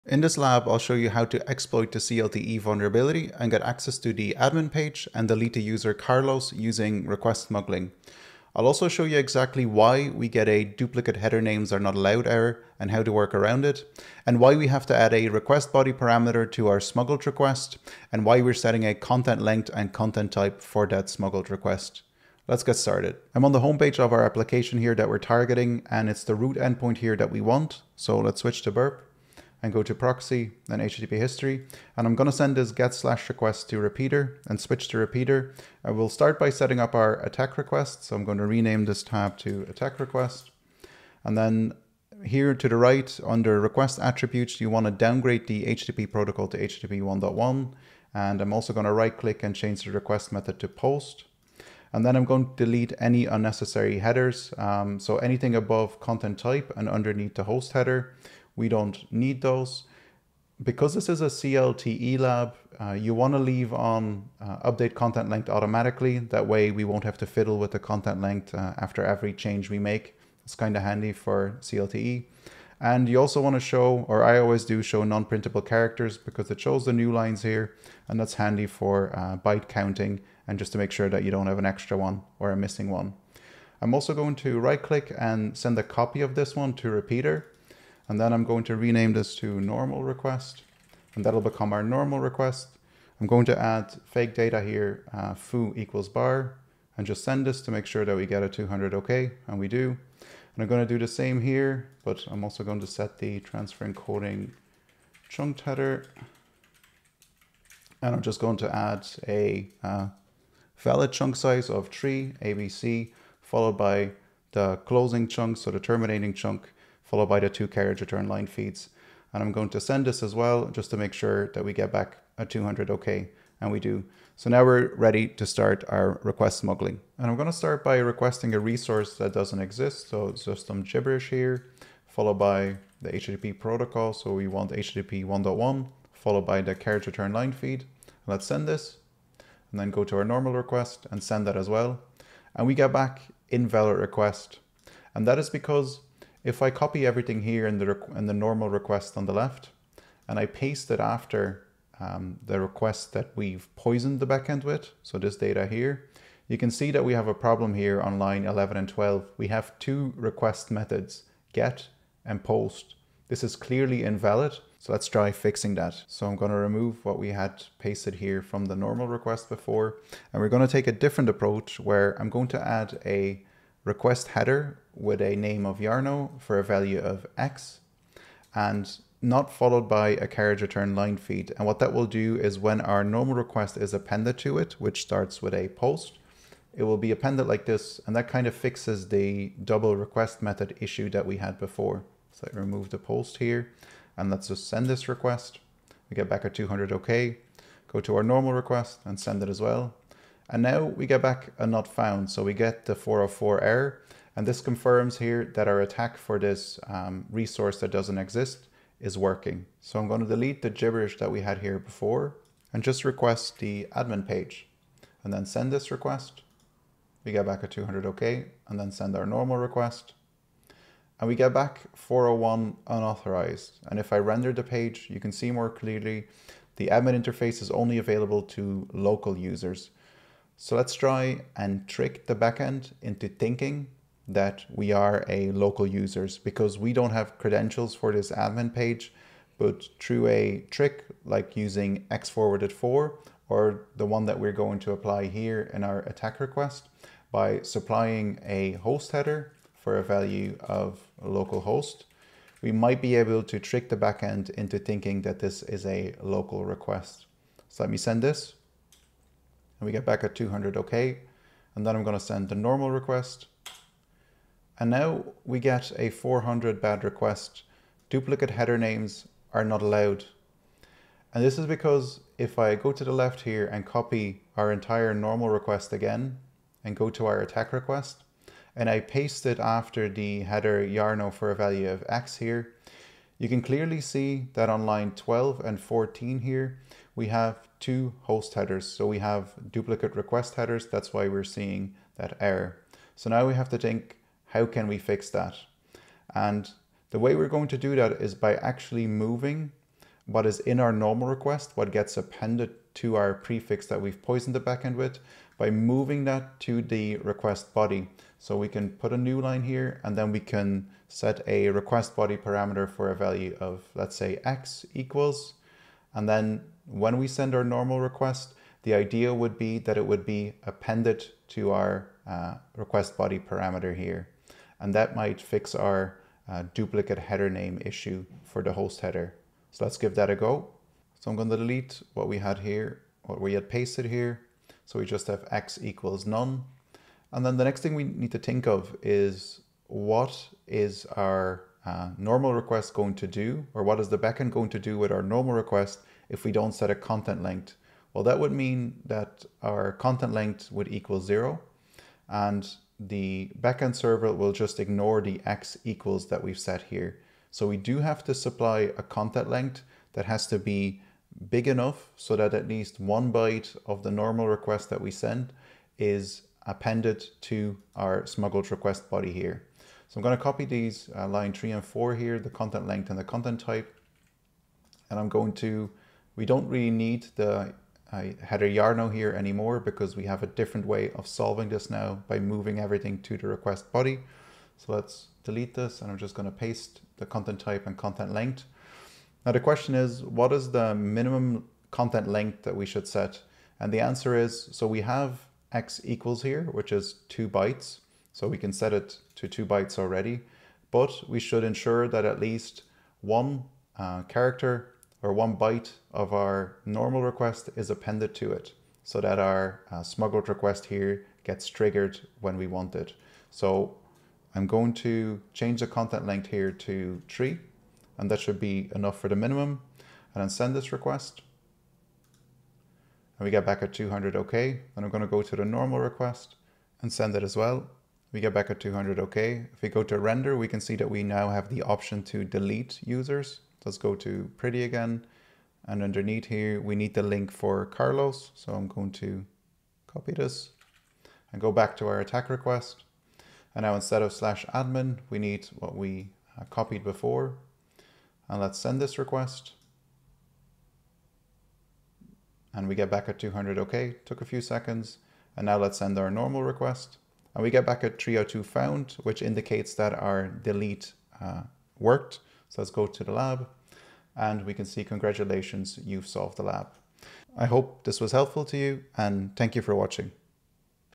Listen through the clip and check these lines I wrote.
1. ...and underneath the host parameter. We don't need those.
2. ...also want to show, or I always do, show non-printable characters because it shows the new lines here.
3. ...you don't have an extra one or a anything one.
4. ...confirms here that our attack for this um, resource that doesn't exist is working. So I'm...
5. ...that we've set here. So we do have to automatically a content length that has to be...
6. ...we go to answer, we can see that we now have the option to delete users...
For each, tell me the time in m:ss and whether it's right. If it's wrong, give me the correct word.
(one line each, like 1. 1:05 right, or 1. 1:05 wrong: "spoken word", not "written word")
1. 0:56 wrong: "header", not "parameter"
2. 1:13 right
3. 1:21 wrong: "missing", not "anything"
4. 3:24 right
5. 5:56 wrong: "supply", not "automatically"
6. 7:09 wrong: "render", not "answer".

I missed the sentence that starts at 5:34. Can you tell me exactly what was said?
So we just have x equals none.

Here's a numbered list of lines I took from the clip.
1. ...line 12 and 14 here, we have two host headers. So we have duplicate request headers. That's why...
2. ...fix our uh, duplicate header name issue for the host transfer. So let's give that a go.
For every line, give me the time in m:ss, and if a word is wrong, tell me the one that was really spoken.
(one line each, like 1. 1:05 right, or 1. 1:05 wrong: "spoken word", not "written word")
1. 4:44 right
2. 5:25 wrong: "header", not "transfer".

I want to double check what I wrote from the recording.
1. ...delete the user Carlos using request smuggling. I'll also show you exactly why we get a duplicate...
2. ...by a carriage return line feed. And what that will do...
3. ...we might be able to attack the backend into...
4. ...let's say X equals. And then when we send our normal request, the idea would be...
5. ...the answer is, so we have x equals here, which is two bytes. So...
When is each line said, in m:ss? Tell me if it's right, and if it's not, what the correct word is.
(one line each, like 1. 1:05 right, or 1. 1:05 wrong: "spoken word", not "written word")
1. 0:05 right
2. 2:59 right
3. 4:12 wrong: "trick", not "attack"
4. 5:13 right
5. 6:33 right.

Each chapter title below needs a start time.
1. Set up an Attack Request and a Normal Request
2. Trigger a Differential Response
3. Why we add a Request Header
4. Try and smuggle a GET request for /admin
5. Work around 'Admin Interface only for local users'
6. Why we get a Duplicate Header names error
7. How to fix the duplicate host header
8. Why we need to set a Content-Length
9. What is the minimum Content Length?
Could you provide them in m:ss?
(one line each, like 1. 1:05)
1. 0:23
2. 2:07
3. 2:26
4. 3:29
5. 3:50
6. 4:24
7. 4:54
8. 5:37
9. 6:30.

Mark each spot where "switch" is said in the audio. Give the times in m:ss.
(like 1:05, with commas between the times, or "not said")
0:28, 0:34.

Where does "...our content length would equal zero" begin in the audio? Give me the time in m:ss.
5:49.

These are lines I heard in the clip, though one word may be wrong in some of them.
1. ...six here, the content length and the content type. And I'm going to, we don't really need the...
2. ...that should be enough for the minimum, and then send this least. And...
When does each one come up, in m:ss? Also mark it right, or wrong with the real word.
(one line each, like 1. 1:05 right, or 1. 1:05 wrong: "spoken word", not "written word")
1. 6:11 wrong: "four", not "six"
2. 6:58 wrong: "request", not "least".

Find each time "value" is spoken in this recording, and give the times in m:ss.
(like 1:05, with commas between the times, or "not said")
2:56, 4:10, 4:41, 5:13.